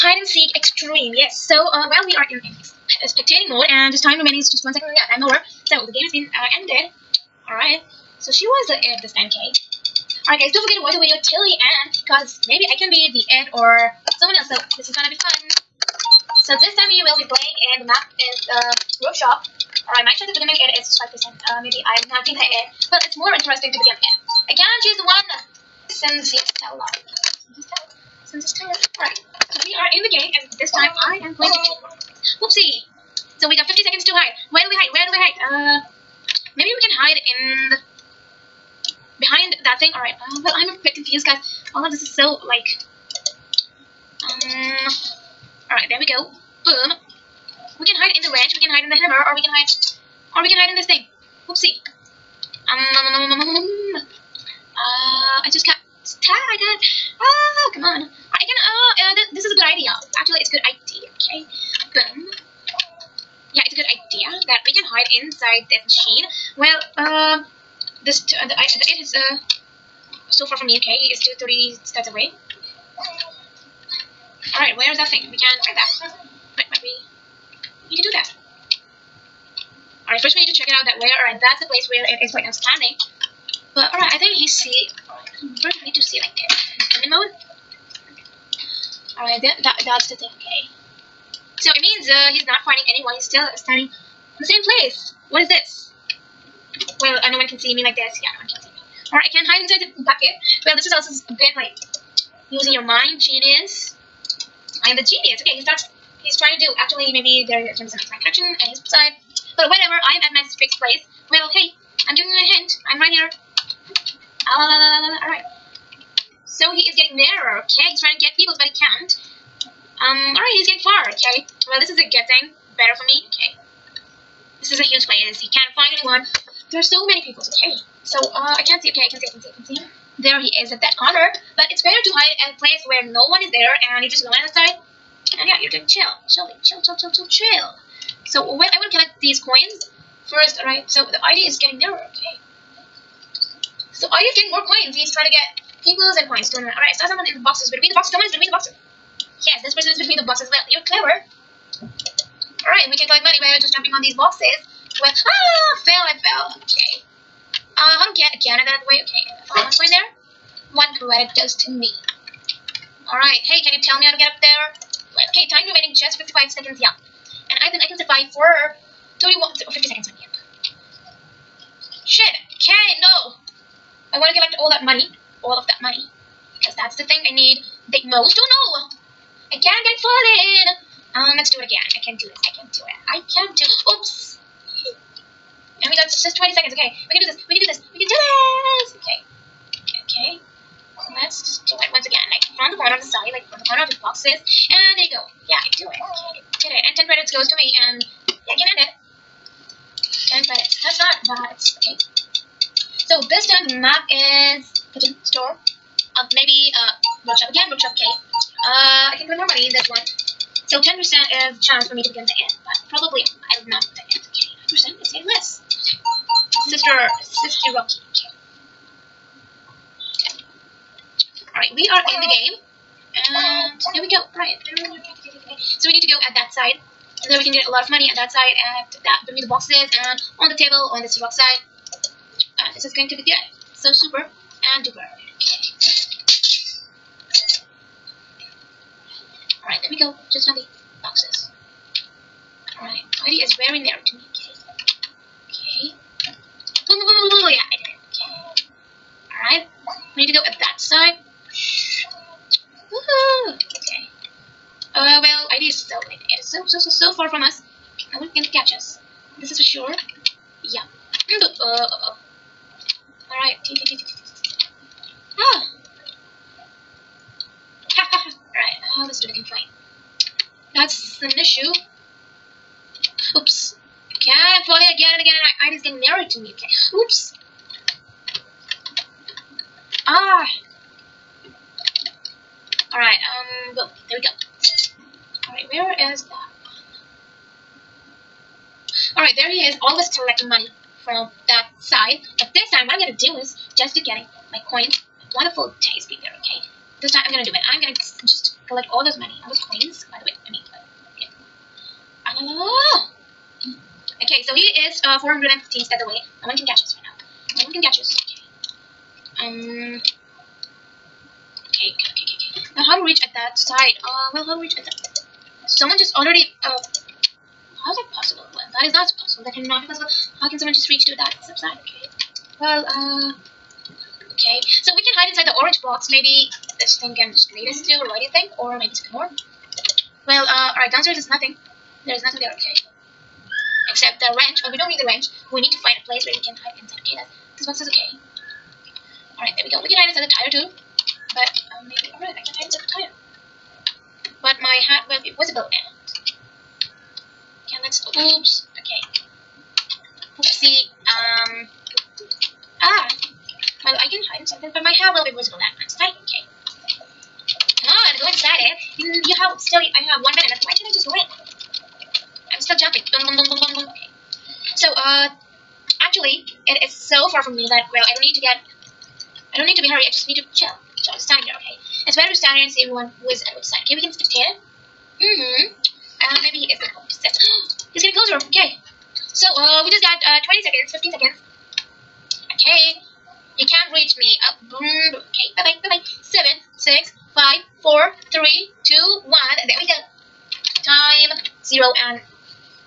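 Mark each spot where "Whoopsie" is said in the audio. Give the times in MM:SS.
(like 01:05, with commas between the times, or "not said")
00:32, 00:51.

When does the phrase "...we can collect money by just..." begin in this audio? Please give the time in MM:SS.
02:32.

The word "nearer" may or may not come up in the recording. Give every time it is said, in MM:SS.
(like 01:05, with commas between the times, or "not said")
01:57, 02:21, 04:35.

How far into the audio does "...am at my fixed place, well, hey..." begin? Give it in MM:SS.
01:50.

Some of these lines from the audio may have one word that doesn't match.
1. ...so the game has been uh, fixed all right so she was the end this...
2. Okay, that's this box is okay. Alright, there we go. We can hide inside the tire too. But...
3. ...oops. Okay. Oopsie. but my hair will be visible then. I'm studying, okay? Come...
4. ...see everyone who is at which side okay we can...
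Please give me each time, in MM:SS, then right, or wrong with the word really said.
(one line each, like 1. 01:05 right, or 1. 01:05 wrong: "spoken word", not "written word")
1. 00:05 wrong: "ended", not "fixed"
2. 05:37 right
3. 05:48 right
4. 06:12 right.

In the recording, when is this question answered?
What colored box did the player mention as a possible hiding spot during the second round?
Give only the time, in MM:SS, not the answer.
05:25.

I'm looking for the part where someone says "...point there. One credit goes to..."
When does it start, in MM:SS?
02:39.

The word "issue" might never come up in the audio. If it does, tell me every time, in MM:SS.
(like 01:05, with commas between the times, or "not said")
04:31.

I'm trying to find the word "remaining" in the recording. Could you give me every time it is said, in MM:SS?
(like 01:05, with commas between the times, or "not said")
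00:04, 02:45.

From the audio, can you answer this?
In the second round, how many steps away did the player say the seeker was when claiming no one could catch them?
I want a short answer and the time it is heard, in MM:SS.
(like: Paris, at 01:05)
415, at 05:05.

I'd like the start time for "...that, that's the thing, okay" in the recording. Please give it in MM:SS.
01:29.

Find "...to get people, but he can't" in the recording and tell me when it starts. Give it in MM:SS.
01:58.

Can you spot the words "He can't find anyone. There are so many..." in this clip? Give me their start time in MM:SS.
02:05.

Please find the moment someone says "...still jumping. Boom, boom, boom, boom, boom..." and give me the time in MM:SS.
06:02.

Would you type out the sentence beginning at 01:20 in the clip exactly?
Alright, first we need to check it out that where, alright, that's the place where it is right now standing.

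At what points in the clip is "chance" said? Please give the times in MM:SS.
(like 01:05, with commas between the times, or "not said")
00:20, 03:31.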